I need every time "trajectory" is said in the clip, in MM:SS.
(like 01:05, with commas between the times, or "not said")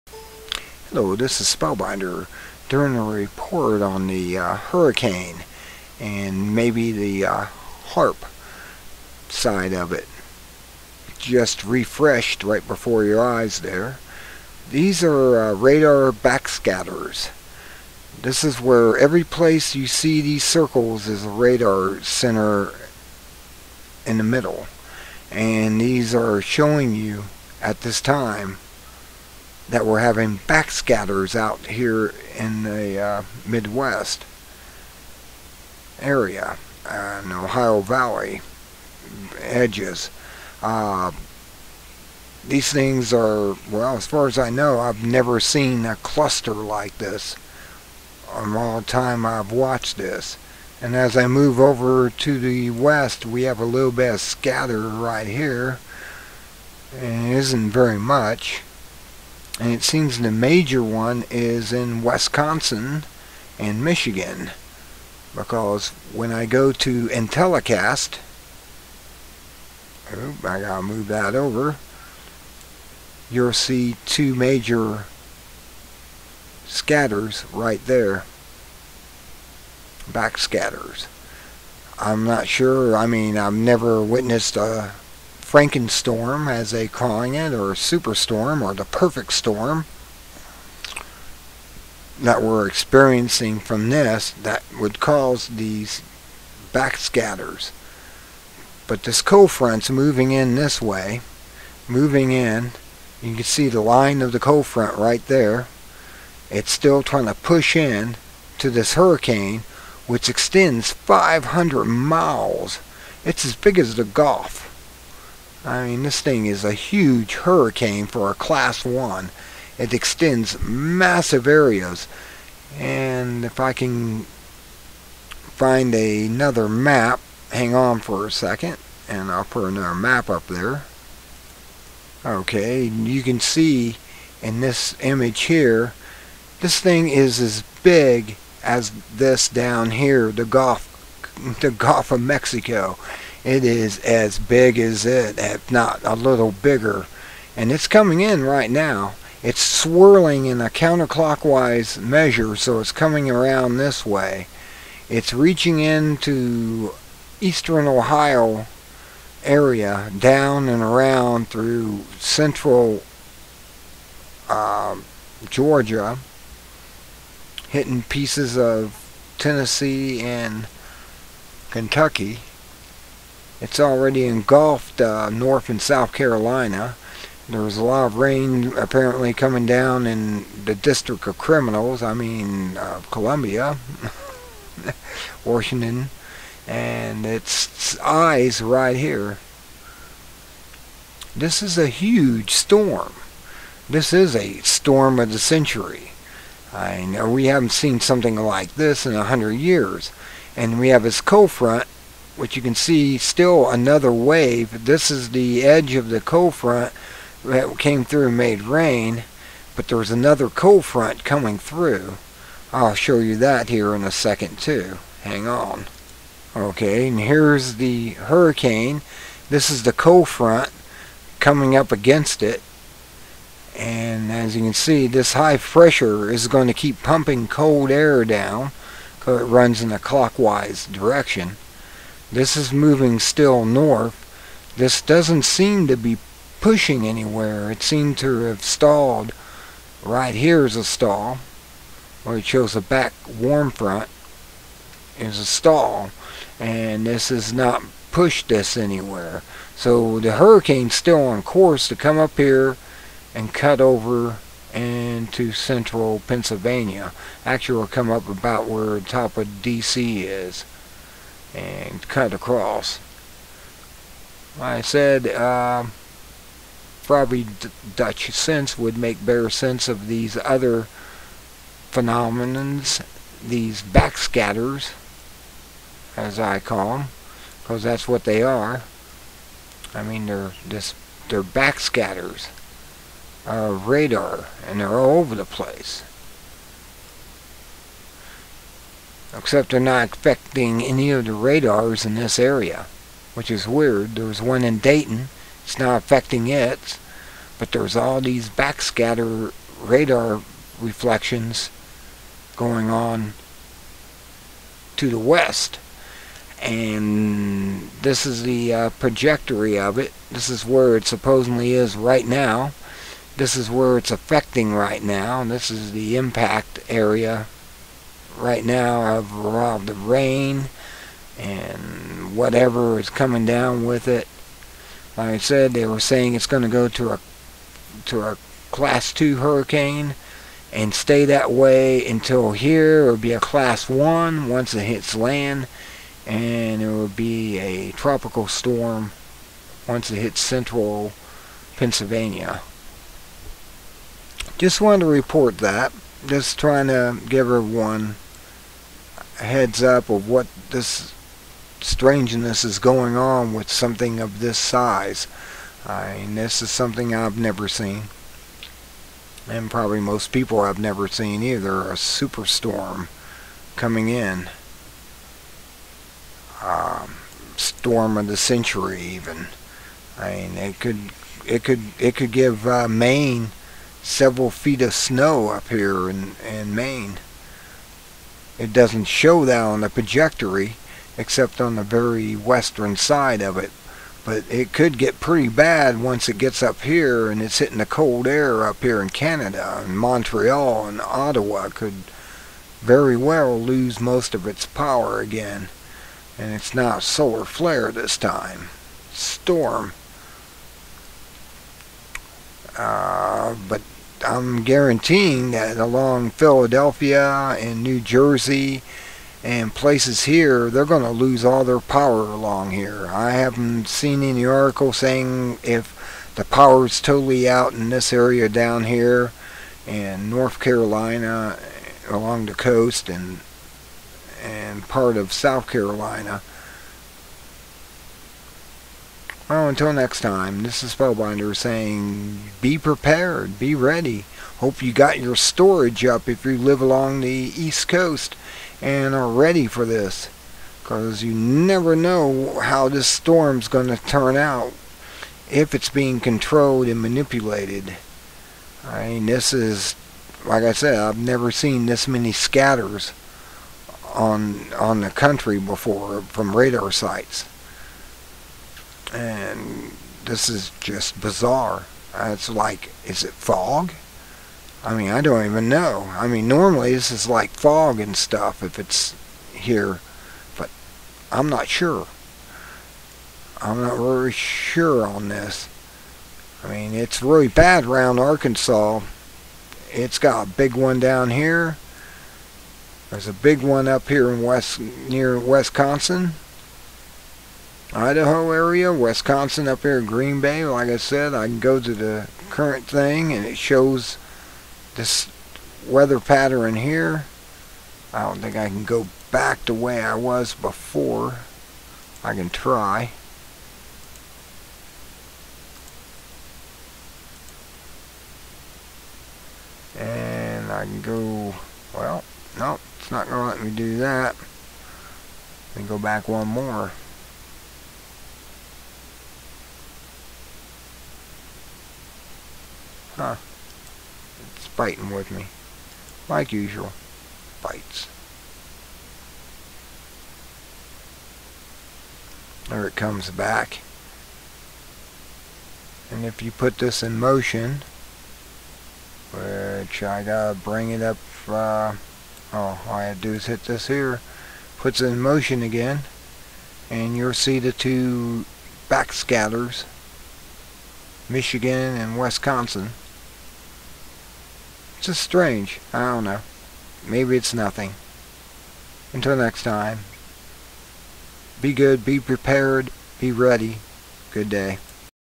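05:08, 06:19.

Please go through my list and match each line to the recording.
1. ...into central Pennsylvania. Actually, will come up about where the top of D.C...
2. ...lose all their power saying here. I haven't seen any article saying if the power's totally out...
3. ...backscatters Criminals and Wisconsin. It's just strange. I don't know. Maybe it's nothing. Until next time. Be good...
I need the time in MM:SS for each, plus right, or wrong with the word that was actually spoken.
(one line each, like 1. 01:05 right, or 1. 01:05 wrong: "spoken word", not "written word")
1. 04:14 right
2. 06:51 wrong: "along", not "saying"
3. 09:08 wrong: "Michigan", not "Criminals".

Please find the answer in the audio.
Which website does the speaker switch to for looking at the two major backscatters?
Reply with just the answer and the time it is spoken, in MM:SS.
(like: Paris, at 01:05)
Intellicast, at 01:07.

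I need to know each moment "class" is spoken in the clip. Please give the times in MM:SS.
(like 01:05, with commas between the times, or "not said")
01:58, 05:28, 05:33.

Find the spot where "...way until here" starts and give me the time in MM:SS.
05:31.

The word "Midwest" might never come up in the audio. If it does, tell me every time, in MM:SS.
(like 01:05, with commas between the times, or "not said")
00:33.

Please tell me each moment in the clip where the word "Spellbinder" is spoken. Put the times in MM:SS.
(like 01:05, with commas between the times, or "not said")
00:01, 07:10.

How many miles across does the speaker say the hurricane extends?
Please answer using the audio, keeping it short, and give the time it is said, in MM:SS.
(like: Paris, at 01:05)
500, at 01:50.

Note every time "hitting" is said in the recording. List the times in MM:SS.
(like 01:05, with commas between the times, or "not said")
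02:47, 06:27.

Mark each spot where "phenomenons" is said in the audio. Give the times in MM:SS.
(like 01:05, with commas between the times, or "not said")
04:31.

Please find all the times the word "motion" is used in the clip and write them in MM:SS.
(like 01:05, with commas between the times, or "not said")
08:57, 09:05.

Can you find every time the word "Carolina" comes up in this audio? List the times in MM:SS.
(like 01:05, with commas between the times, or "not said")
02:56, 07:00, 07:05.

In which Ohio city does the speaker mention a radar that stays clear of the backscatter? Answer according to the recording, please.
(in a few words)
Dayton.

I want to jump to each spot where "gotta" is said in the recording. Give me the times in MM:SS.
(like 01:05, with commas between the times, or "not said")
01:10, 09:00.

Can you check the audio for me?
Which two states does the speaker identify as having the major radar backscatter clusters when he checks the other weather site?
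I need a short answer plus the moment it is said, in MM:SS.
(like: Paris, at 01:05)
Wisconsin and Michigan, at 01:02.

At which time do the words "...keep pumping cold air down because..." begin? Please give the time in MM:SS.
03:46.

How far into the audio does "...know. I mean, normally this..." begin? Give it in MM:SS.
07:45.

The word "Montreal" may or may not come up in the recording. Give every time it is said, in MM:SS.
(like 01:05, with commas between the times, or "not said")
06:29.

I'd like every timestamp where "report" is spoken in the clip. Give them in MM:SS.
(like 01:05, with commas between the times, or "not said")
00:03, 05:45.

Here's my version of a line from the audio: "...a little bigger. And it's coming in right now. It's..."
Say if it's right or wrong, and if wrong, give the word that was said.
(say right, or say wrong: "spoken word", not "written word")
right.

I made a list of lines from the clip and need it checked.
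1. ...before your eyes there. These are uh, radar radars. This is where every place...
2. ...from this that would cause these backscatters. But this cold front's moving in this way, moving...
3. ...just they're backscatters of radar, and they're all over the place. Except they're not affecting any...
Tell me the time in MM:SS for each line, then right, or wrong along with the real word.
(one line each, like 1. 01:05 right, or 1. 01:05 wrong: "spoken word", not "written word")
1. 00:12 wrong: "backscatters", not "radars"
2. 01:33 right
3. 04:40 right.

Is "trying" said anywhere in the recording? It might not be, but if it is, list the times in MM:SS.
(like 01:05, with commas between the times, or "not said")
01:47, 05:46.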